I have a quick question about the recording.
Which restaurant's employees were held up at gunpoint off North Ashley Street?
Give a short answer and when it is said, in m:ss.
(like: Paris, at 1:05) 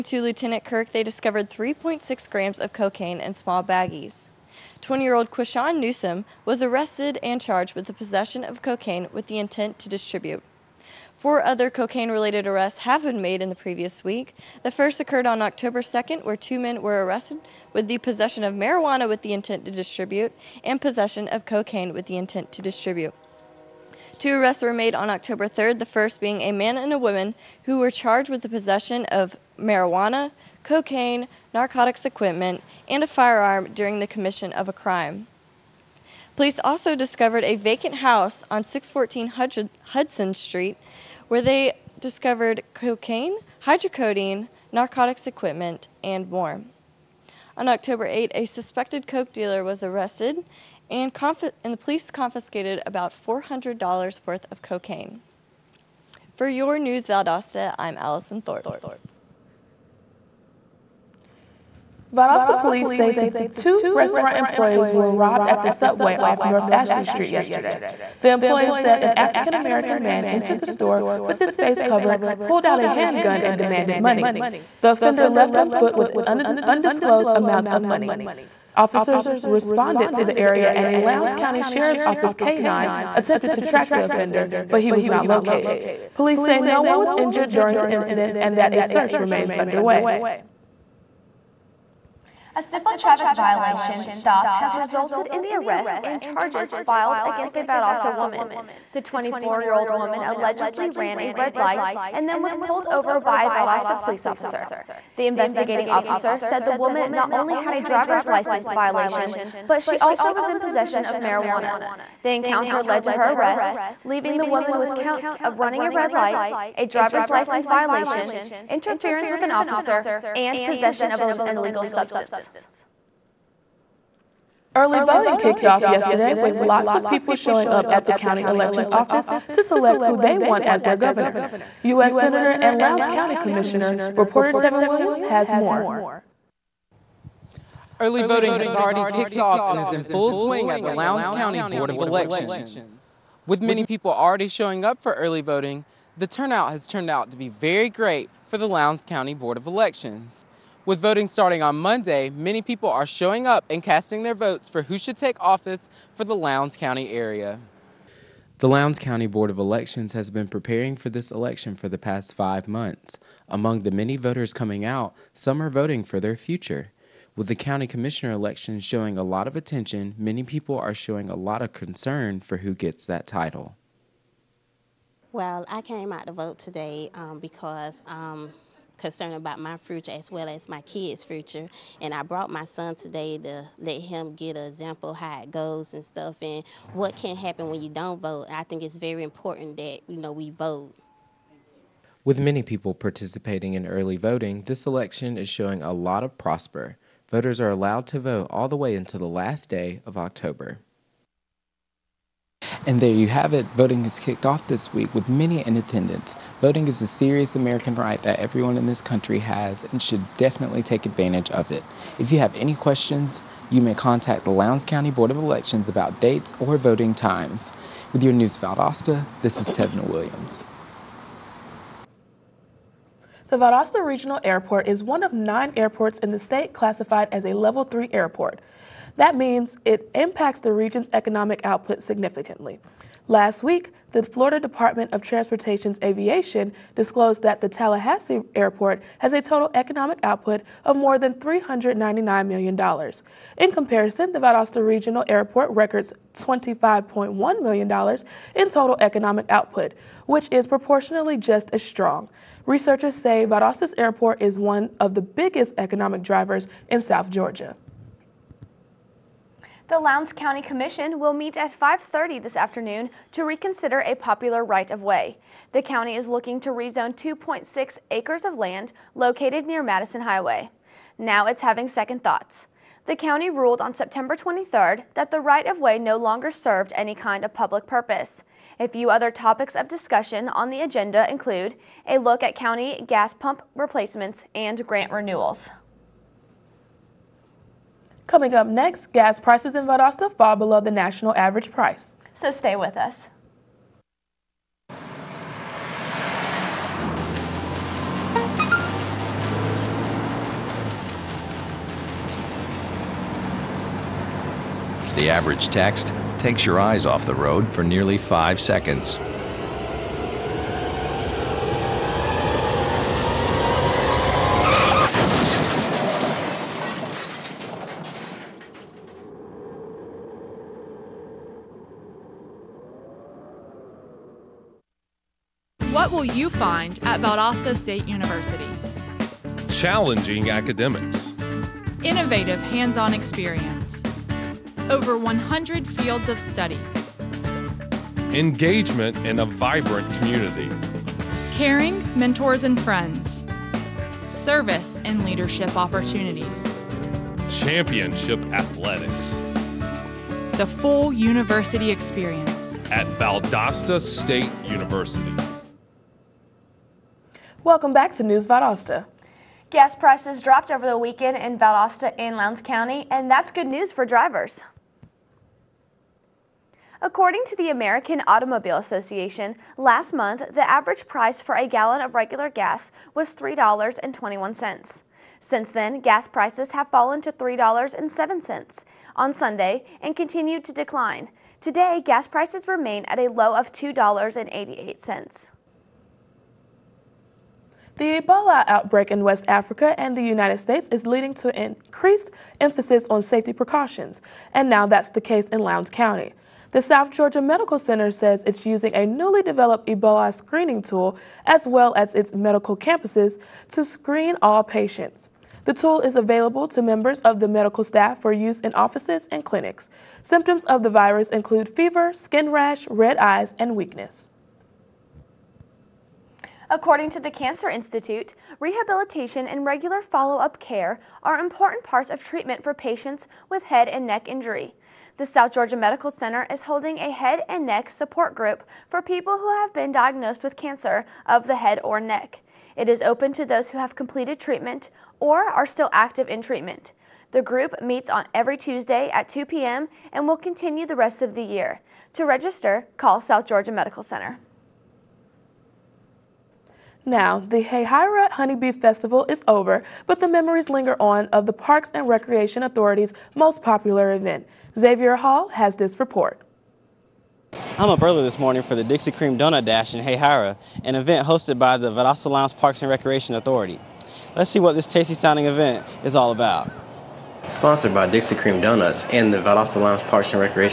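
Subway, at 1:05.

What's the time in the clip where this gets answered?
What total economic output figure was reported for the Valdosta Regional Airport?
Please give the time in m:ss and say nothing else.
4:06.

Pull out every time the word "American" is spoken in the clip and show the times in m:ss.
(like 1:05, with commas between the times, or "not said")
1:09, 3:27, 6:07.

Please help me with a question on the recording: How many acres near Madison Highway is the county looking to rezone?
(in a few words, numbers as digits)
2.6 acres.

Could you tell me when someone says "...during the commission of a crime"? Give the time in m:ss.
0:33.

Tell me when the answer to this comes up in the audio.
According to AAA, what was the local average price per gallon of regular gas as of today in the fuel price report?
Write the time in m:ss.
6:23.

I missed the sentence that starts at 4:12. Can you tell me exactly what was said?
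Researchers say Valdosta's airport is one of the biggest economic drivers in South Georgia.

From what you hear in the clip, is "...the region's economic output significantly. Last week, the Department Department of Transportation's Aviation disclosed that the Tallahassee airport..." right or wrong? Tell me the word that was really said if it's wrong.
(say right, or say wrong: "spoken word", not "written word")
wrong: "Florida", not "Department".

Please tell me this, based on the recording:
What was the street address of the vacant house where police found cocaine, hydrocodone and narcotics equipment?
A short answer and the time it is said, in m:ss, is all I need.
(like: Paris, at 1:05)
614 Hudson Street, at 0:38.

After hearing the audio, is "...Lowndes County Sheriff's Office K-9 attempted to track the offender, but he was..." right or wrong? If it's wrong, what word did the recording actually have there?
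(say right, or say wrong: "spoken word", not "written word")
right.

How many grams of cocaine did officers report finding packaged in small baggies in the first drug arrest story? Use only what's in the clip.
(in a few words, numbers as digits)
3.6 grams.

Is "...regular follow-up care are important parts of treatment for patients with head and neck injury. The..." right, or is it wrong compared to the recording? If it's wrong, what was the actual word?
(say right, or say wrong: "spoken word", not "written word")
right.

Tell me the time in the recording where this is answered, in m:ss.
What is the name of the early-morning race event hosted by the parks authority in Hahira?
7:38.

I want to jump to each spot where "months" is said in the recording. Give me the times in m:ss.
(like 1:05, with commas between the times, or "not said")
2:42, 6:10.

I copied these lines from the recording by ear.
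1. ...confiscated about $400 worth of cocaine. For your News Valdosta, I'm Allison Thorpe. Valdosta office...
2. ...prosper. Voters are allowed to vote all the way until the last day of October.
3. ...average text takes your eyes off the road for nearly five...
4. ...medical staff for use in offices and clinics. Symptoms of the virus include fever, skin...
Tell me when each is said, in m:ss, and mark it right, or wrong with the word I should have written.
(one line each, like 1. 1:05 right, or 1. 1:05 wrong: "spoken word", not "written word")
1. 0:52 wrong: "police", not "office"
2. 3:16 right
3. 5:05 right
4. 6:47 right.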